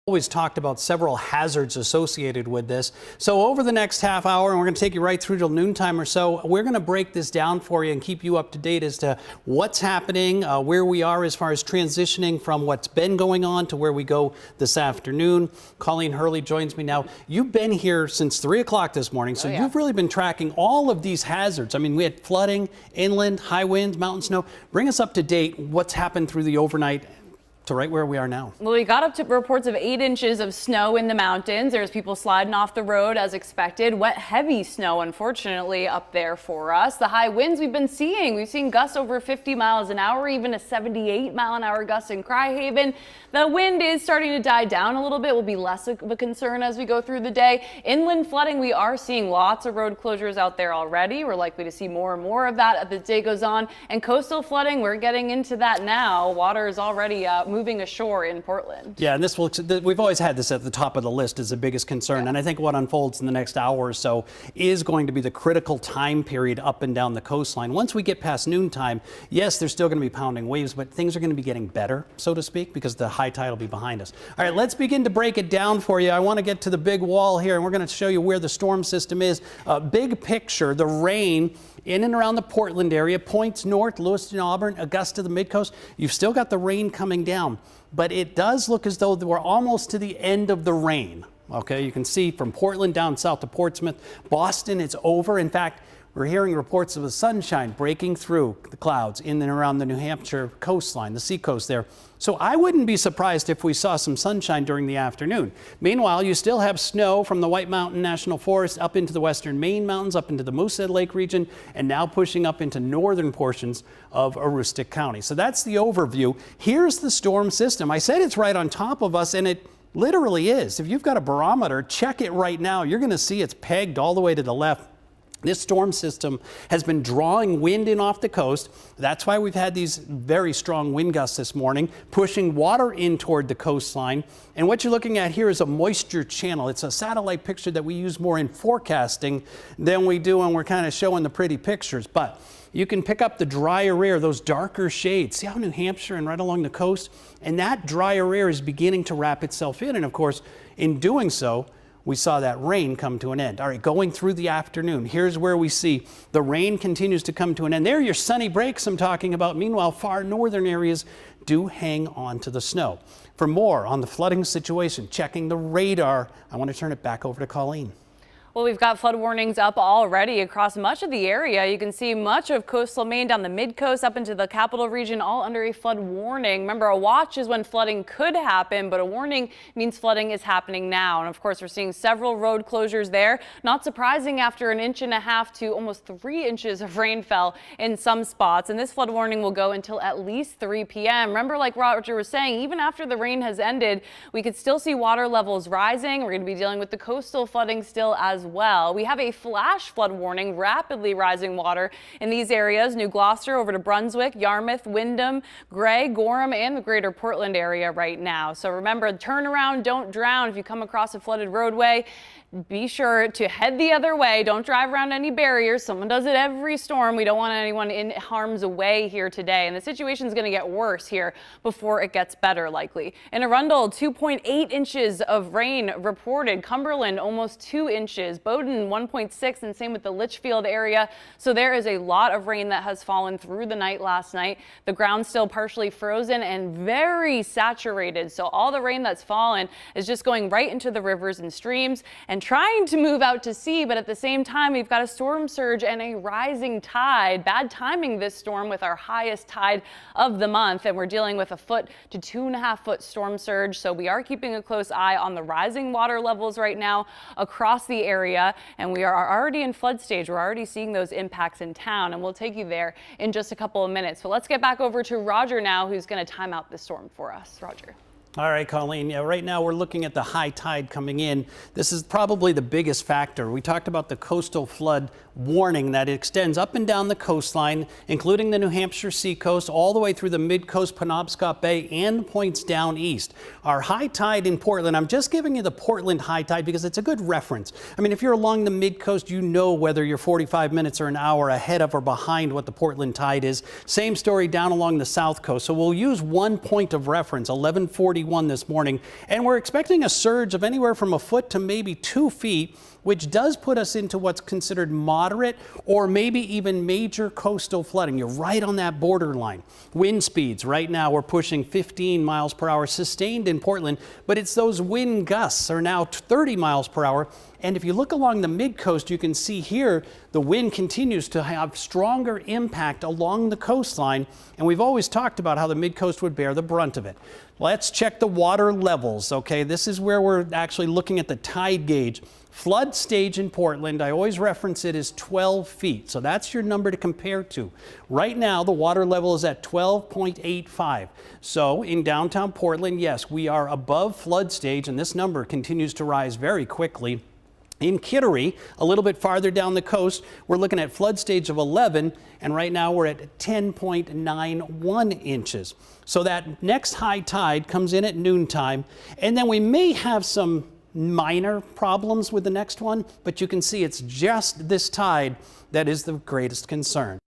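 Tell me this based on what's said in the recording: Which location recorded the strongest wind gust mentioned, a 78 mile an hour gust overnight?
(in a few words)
Criehaven.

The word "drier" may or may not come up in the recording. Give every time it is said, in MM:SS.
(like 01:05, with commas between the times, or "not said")
02:23, 02:27.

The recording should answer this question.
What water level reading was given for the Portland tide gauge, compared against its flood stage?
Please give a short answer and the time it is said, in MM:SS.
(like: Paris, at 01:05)
12.85, at 05:39.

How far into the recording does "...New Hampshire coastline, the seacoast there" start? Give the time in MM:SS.
01:39.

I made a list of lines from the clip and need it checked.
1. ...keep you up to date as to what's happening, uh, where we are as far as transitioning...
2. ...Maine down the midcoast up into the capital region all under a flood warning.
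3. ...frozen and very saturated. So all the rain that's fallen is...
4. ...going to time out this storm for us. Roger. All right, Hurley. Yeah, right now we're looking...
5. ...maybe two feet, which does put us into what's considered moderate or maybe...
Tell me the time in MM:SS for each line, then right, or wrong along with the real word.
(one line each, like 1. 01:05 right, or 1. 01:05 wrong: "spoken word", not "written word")
1. 00:08 right
2. 02:53 right
3. 03:55 right
4. 04:26 wrong: "Colleen", not "Hurley"
5. 05:01 right.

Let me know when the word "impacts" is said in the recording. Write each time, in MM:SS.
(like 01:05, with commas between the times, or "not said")
04:21, 05:22.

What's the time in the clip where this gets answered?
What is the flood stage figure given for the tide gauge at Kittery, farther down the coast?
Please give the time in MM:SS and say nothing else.
05:51.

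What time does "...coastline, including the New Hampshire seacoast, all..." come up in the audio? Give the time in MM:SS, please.
04:37.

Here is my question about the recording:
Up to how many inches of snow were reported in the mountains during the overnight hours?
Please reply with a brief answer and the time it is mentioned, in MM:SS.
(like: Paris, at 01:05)
8 inches, at 00:29.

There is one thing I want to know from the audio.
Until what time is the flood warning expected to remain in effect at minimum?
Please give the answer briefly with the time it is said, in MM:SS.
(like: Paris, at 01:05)
3 p.m., at 03:10.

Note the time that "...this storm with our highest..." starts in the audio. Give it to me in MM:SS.
04:08.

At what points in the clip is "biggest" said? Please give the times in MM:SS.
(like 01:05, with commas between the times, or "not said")
01:01, 04:32.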